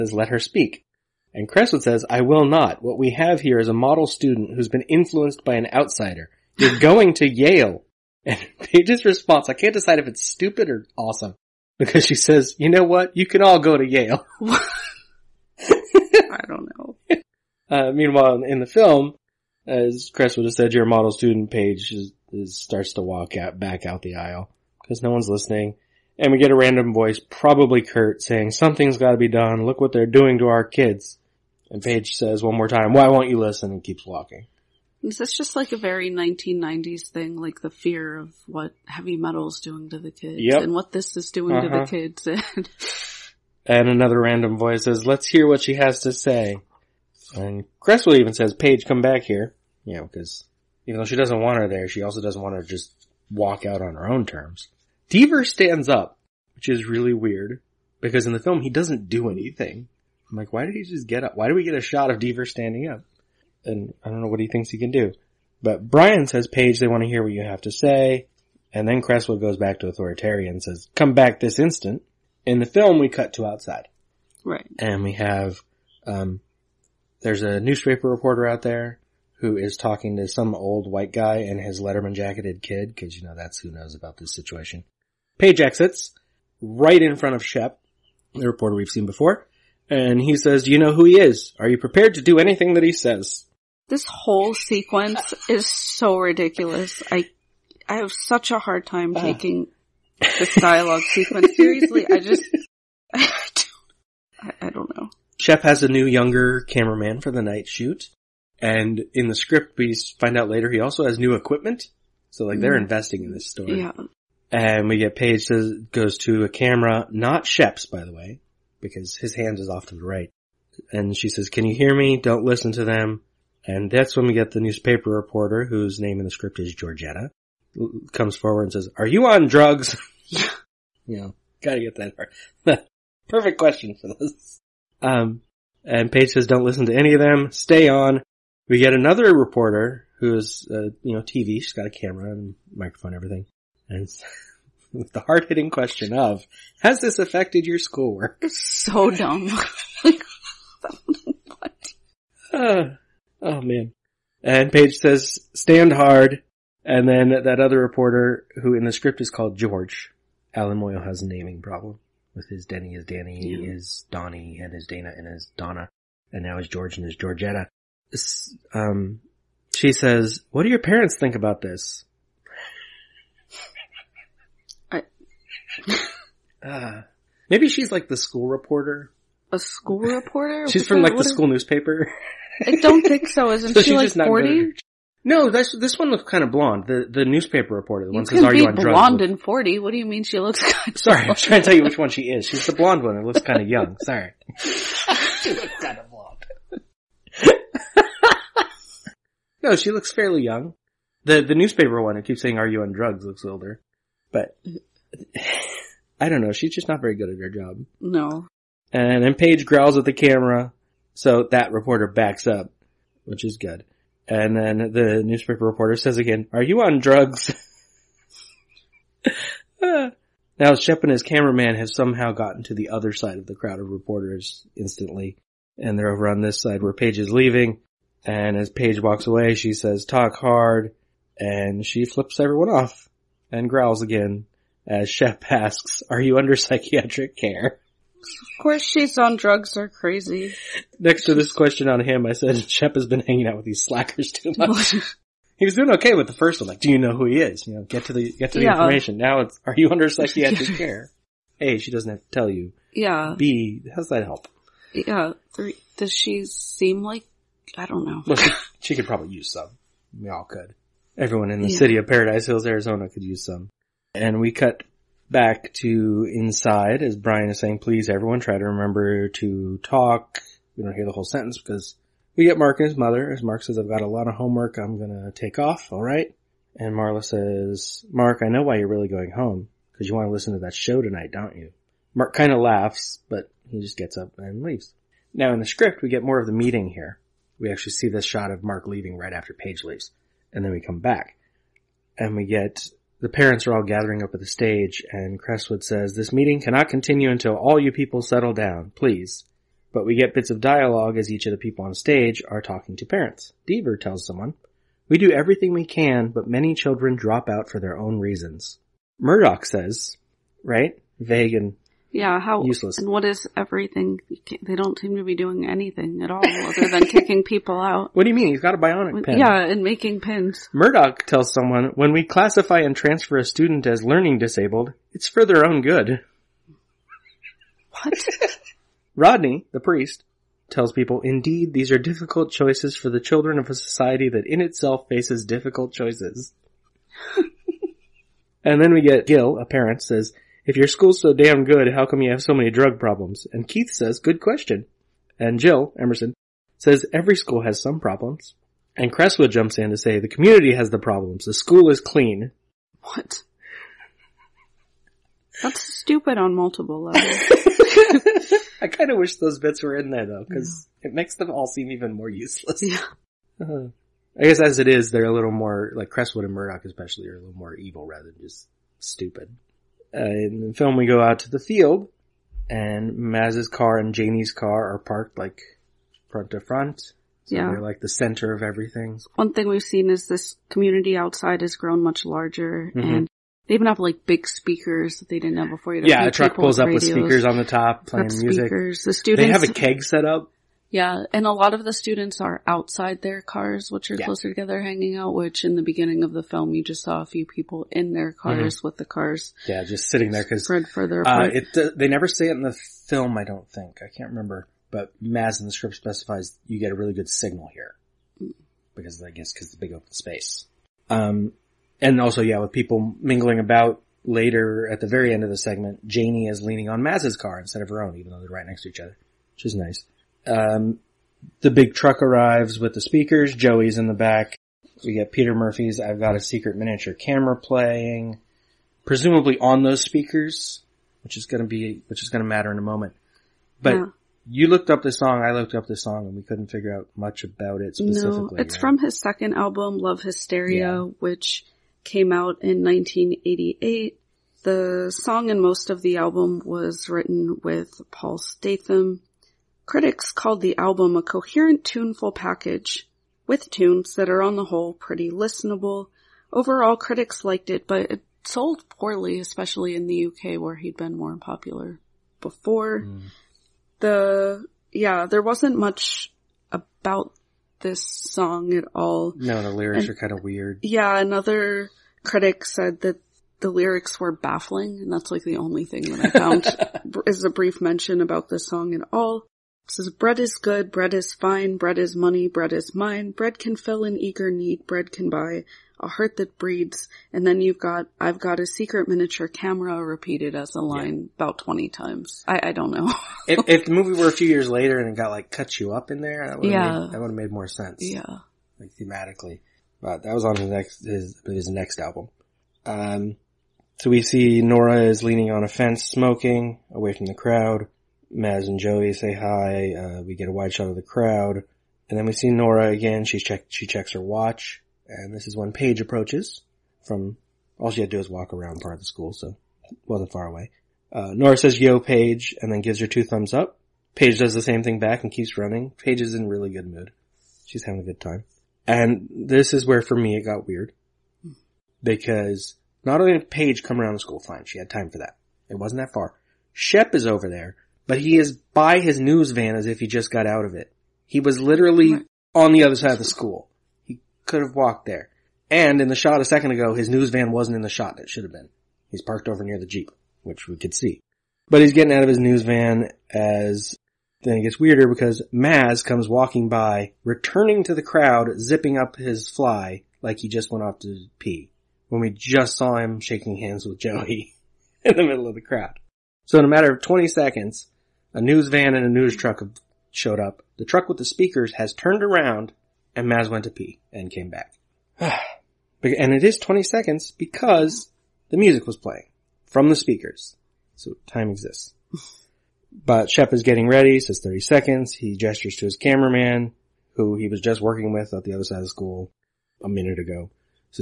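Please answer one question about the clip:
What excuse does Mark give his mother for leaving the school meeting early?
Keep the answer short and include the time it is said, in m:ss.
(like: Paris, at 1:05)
A lot of homework, at 4:34.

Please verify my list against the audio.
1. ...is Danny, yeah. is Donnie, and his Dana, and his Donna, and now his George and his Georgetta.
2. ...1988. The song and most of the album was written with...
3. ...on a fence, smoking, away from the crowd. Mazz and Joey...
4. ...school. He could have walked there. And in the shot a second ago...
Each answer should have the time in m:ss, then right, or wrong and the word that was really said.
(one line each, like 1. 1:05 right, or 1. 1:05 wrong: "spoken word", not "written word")
1. 2:42 right
2. 7:22 right
3. 8:25 right
4. 9:03 right.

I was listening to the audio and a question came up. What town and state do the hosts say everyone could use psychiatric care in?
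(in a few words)
Paradise Hills, Arizona.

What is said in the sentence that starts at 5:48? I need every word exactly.
And Creswood jumps in to say the community has the problems.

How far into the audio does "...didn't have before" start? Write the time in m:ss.
6:25.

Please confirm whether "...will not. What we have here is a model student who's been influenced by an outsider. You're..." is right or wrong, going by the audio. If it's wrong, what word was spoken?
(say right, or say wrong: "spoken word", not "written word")
right.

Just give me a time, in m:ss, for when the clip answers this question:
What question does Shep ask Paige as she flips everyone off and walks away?
3:56.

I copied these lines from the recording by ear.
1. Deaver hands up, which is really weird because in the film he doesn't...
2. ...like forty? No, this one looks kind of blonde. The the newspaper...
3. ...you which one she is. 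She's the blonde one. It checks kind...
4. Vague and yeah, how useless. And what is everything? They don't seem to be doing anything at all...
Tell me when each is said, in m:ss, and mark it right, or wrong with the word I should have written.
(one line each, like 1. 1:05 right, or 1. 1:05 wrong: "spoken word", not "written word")
1. 0:55 wrong: "stands", not "hands"
2. 3:03 right
3. 3:11 wrong: "looks", not "checks"
4. 5:11 right.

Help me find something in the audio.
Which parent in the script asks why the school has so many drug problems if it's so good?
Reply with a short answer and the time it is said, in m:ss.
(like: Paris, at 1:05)
Gil, at 5:39.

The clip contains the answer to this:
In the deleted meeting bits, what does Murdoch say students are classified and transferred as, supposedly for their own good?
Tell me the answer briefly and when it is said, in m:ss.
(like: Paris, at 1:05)
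Learning disabled, at 5:24.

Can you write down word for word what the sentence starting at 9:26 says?
So in a matter of 20 seconds, a news van and a news truck showed up.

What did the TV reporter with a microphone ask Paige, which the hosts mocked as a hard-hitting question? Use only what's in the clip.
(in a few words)
Has this affected your schoolwork.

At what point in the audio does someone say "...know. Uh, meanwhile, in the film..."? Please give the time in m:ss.
0:16.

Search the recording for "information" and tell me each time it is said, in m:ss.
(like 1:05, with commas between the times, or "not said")
4:08.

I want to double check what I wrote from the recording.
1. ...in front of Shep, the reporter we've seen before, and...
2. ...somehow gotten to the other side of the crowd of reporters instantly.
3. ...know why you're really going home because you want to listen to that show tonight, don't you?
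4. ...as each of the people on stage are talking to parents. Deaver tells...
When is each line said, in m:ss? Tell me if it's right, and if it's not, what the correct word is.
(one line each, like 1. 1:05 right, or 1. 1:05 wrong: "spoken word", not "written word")
1. 1:27 right
2. 3:41 right
3. 4:38 right
4. 5:01 right.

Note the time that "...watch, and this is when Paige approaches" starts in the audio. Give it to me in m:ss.
8:34.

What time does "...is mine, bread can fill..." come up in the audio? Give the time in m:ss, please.
8:02.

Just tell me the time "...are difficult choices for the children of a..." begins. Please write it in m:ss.
5:31.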